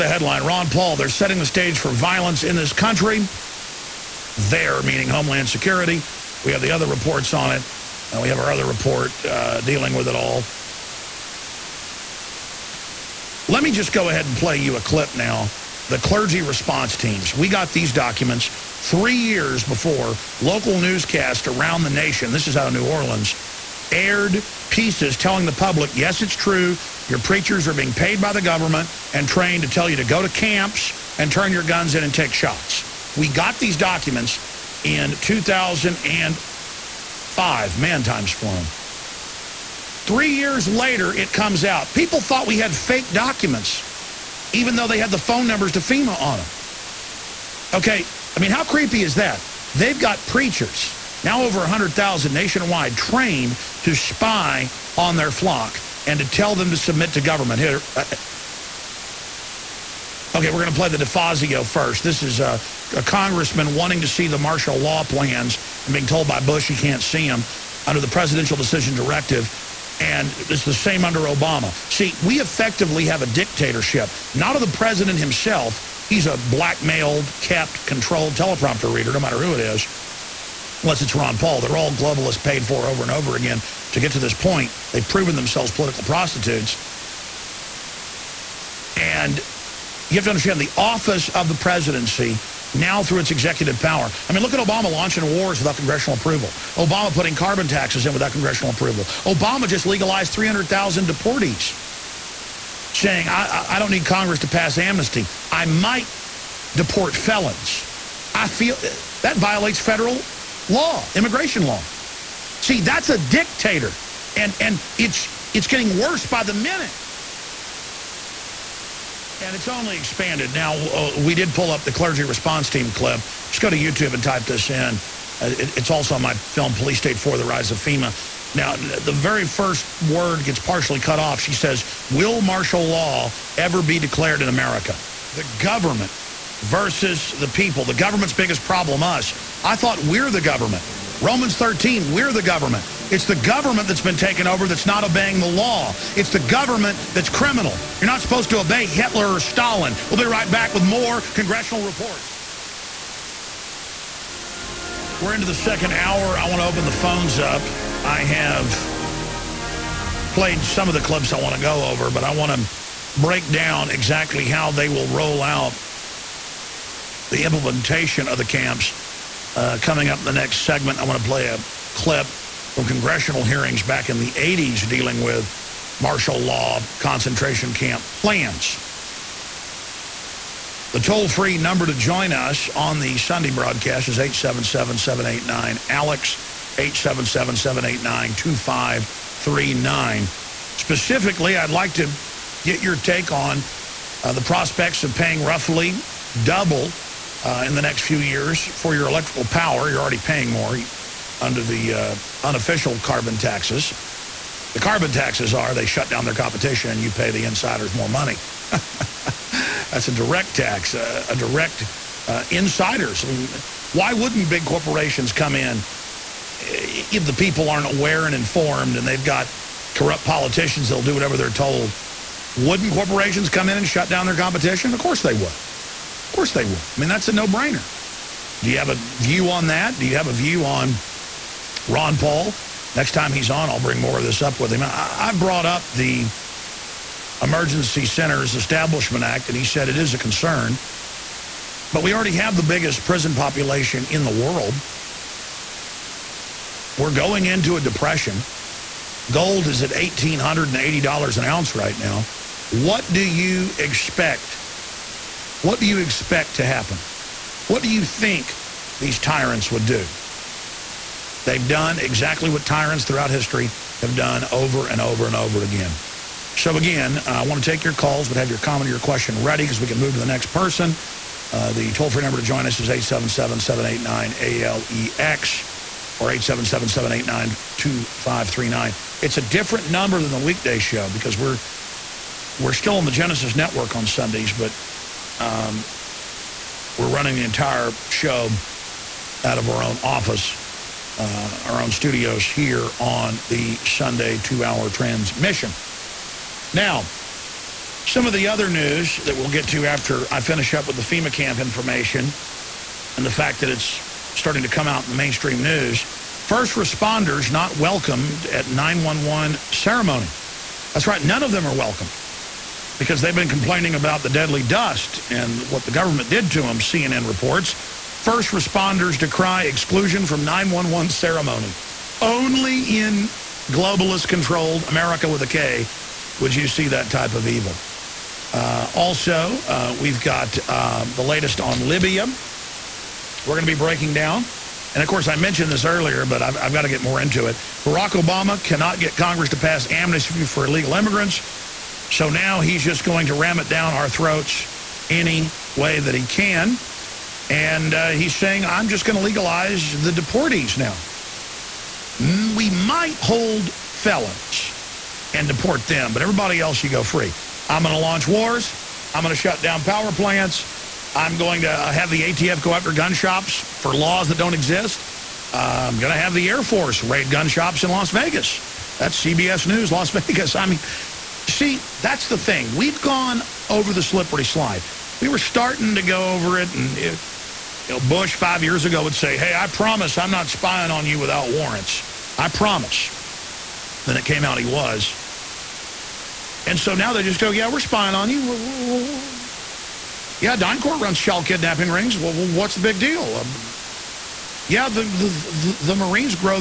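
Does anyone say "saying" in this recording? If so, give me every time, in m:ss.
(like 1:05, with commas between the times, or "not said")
1:42, 5:48.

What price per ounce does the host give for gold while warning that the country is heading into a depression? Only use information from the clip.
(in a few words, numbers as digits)
$1,880.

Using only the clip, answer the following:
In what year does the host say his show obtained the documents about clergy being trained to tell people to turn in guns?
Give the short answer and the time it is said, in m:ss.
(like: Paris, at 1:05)
2005, at 0:35.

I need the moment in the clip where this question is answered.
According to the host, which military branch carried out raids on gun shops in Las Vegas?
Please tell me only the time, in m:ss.
6:06.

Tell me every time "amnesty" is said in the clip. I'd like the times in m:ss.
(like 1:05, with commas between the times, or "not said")
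1:44, 5:39.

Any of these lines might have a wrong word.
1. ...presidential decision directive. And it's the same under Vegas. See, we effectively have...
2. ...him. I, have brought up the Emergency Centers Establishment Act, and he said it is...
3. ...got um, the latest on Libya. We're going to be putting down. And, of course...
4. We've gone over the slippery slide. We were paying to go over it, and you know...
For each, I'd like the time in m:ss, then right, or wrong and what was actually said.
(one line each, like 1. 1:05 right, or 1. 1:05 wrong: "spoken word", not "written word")
1. 1:08 wrong: "Obama", not "Vegas"
2. 3:54 right
3. 5:30 wrong: "breaking", not "putting"
4. 6:12 wrong: "starting", not "paying".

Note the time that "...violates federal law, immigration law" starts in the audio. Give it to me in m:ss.
1:49.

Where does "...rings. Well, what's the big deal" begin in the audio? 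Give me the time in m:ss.
6:31.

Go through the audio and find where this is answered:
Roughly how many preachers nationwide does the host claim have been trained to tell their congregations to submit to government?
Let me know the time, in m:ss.
0:51.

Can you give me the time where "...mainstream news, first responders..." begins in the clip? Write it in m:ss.
5:05.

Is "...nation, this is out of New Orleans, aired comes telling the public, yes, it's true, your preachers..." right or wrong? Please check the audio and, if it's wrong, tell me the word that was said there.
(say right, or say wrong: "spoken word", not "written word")
wrong: "pieces", not "comes".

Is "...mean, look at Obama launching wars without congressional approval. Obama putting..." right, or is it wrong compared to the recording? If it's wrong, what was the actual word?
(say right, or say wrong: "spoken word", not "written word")
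right.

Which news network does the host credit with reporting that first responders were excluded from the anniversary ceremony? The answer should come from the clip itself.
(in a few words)
CNN.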